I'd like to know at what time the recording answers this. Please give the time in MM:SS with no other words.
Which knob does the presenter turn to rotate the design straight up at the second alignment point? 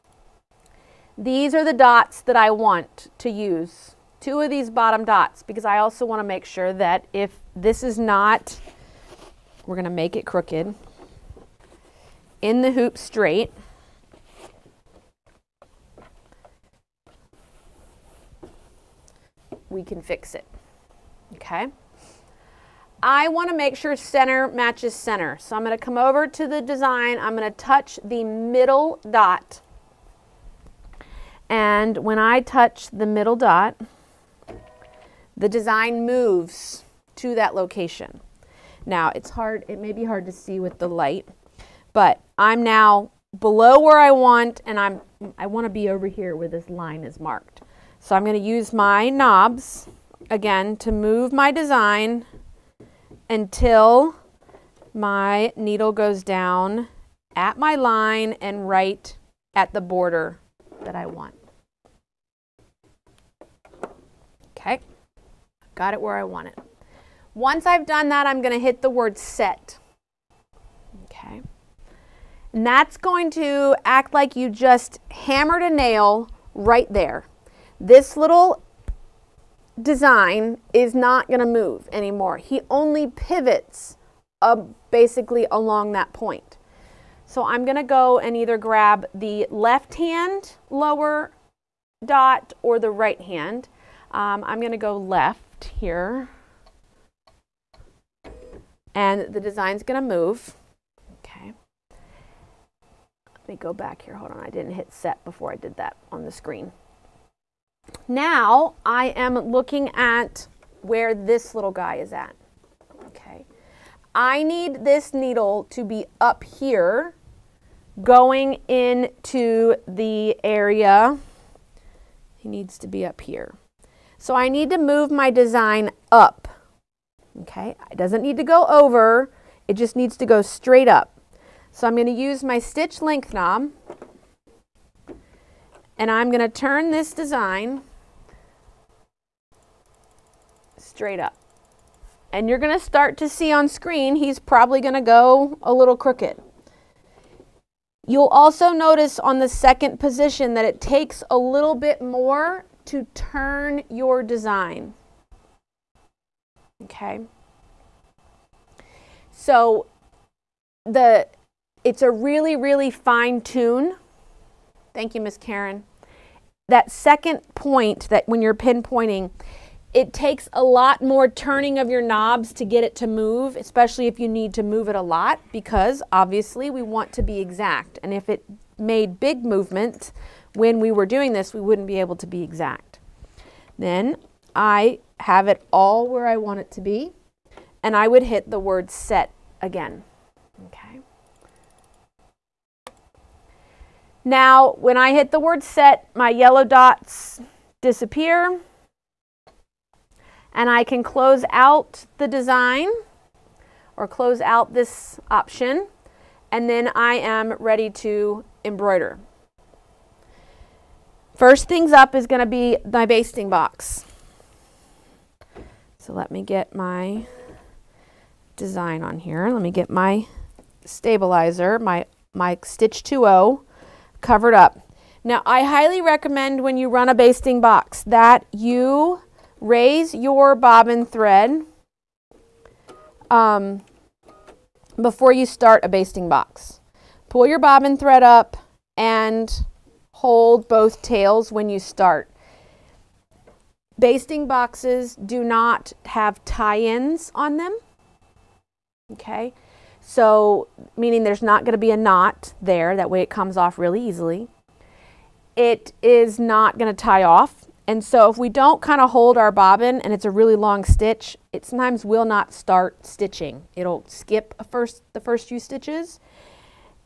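02:12.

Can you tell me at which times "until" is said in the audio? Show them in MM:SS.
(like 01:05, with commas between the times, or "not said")
00:53.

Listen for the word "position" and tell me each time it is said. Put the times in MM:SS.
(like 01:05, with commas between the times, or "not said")
02:30.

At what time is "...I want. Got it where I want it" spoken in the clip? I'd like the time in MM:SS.
01:00.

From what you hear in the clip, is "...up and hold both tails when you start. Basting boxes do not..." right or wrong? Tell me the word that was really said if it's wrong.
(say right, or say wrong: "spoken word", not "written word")
right.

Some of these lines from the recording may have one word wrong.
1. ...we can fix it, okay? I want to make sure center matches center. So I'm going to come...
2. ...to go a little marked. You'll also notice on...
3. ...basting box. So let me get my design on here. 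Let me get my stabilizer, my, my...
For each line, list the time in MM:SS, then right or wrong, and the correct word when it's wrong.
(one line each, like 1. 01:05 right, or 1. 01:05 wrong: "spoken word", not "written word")
1. 00:19 right
2. 02:24 wrong: "crooked", not "marked"
3. 03:33 right.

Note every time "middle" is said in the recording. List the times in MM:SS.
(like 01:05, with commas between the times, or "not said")
00:28, 00:33.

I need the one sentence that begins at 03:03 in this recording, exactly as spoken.
Then I have it all where I want it to be, and I would hit the word set again.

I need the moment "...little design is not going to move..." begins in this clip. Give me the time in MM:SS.
01:18.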